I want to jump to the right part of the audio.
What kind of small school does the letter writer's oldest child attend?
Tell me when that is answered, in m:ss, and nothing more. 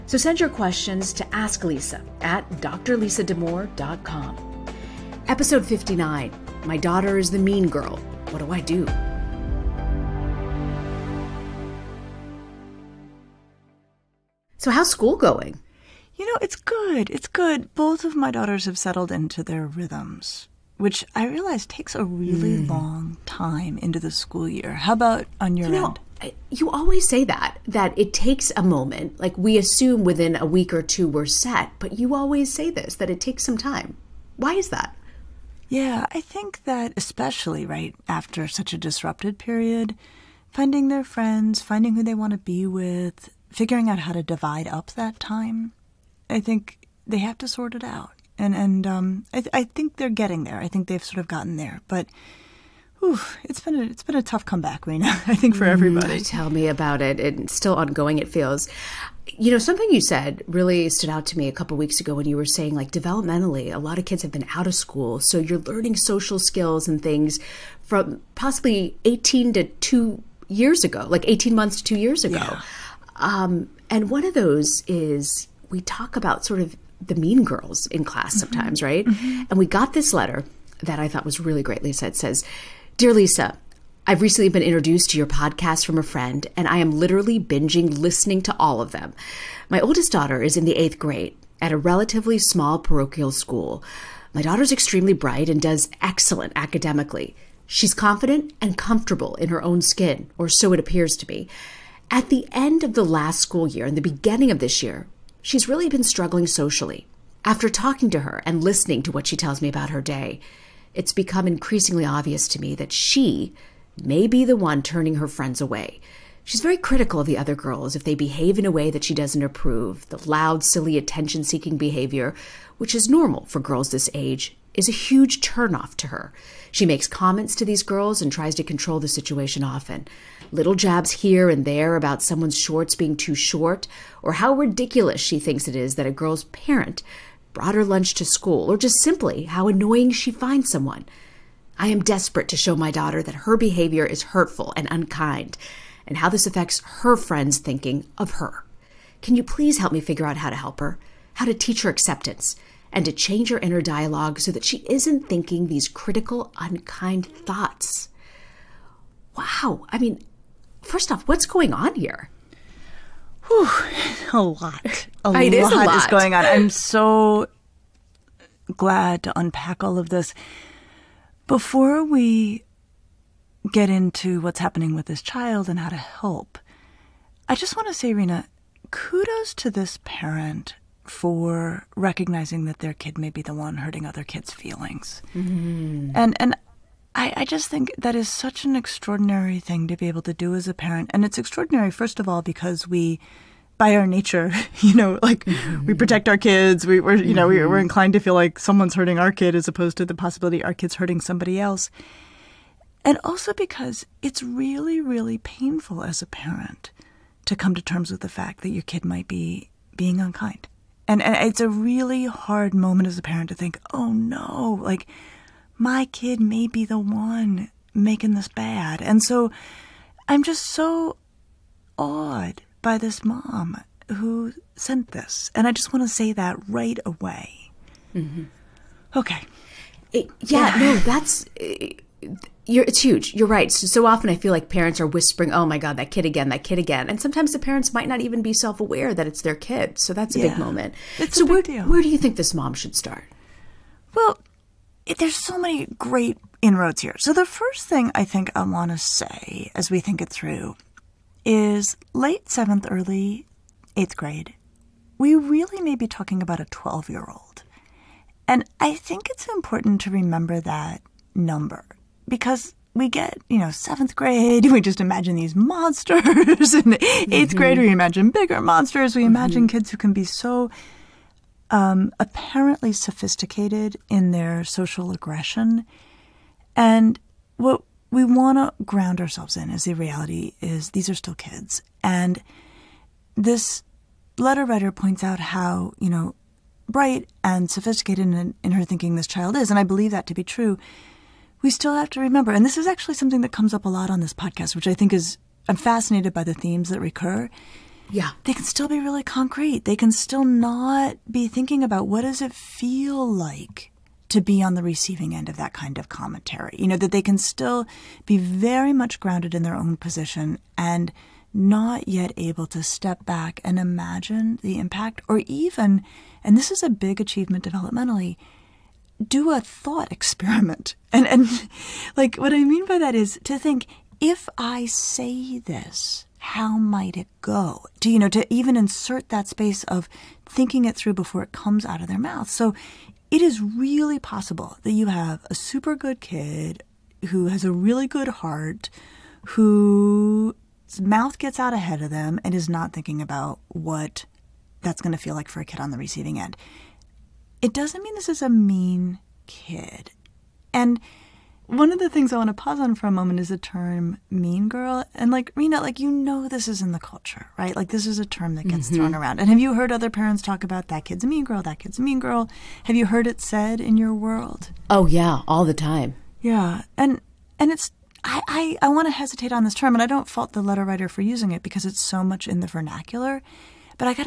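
1:32.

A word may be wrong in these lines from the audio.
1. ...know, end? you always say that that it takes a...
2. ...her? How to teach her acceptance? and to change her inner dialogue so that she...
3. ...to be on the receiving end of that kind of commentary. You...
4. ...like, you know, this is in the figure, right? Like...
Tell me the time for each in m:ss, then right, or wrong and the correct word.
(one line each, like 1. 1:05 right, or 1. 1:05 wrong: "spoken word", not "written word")
1. 0:25 right
2. 2:30 right
3. 5:04 right
4. 5:55 wrong: "culture", not "figure".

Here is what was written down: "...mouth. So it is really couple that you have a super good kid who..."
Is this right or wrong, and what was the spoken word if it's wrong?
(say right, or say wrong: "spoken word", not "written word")
wrong: "possible", not "couple".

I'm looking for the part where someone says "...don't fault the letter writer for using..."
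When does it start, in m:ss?
6:10.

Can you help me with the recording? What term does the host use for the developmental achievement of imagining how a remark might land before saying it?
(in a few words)
thought experiment.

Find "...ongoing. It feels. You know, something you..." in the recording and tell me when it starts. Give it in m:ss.
0:57.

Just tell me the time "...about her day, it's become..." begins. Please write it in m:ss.
1:49.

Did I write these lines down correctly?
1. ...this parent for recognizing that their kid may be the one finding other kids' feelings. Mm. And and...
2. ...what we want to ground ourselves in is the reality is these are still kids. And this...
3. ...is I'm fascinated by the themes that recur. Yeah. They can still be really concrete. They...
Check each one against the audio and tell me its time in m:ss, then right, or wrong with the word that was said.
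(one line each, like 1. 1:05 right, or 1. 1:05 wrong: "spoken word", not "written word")
1. 2:59 wrong: "hurting", not "finding"
2. 4:37 right
3. 4:55 right.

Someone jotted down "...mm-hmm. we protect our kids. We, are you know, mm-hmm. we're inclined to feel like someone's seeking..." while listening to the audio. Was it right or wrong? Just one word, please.
wrong.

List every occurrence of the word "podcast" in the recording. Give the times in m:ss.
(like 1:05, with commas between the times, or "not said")
1:25, 4:54.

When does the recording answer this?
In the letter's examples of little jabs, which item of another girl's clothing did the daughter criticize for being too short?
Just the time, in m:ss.
2:12.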